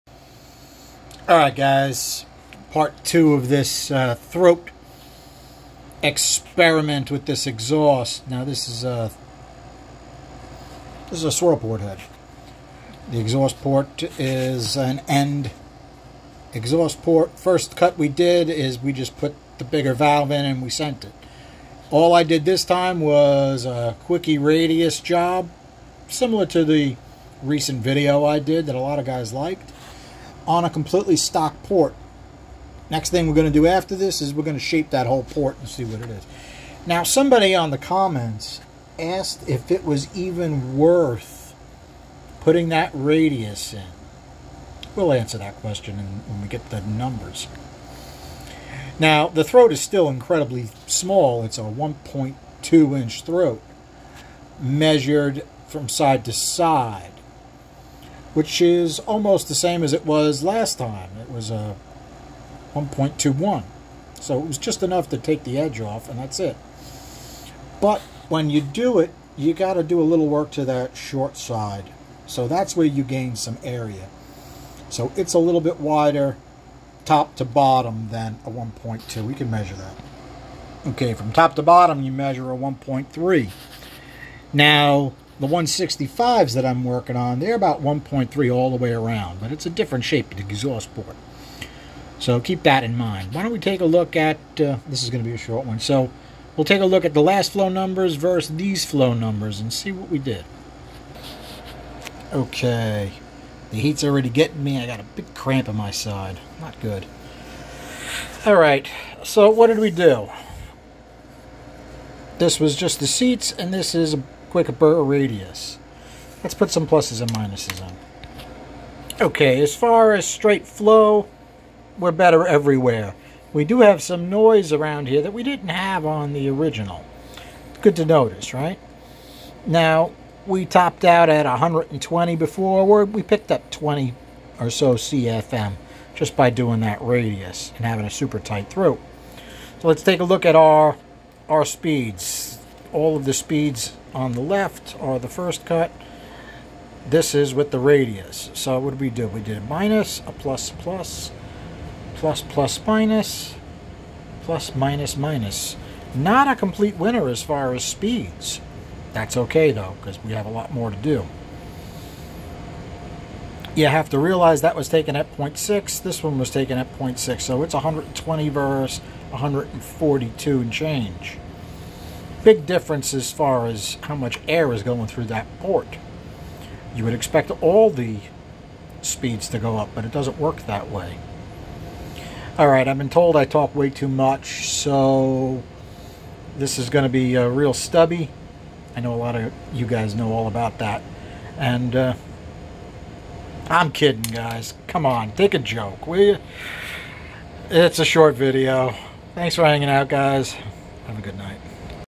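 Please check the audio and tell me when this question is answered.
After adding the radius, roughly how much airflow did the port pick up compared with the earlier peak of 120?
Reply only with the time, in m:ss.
2:13.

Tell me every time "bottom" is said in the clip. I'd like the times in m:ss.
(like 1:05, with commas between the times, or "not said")
1:17, 1:21.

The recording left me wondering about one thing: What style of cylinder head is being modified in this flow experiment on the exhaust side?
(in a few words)
Swirl port head.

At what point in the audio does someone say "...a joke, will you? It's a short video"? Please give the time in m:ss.
3:15.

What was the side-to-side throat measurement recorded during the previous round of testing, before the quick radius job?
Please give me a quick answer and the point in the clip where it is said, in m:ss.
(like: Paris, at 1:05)
1.21, at 1:02.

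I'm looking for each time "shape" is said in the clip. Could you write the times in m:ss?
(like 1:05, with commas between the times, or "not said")
0:34, 1:30.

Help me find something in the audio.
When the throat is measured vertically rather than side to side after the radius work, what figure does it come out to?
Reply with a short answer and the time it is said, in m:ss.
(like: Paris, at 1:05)
1.3, at 1:22.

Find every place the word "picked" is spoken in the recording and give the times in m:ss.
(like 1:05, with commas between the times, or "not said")
2:13.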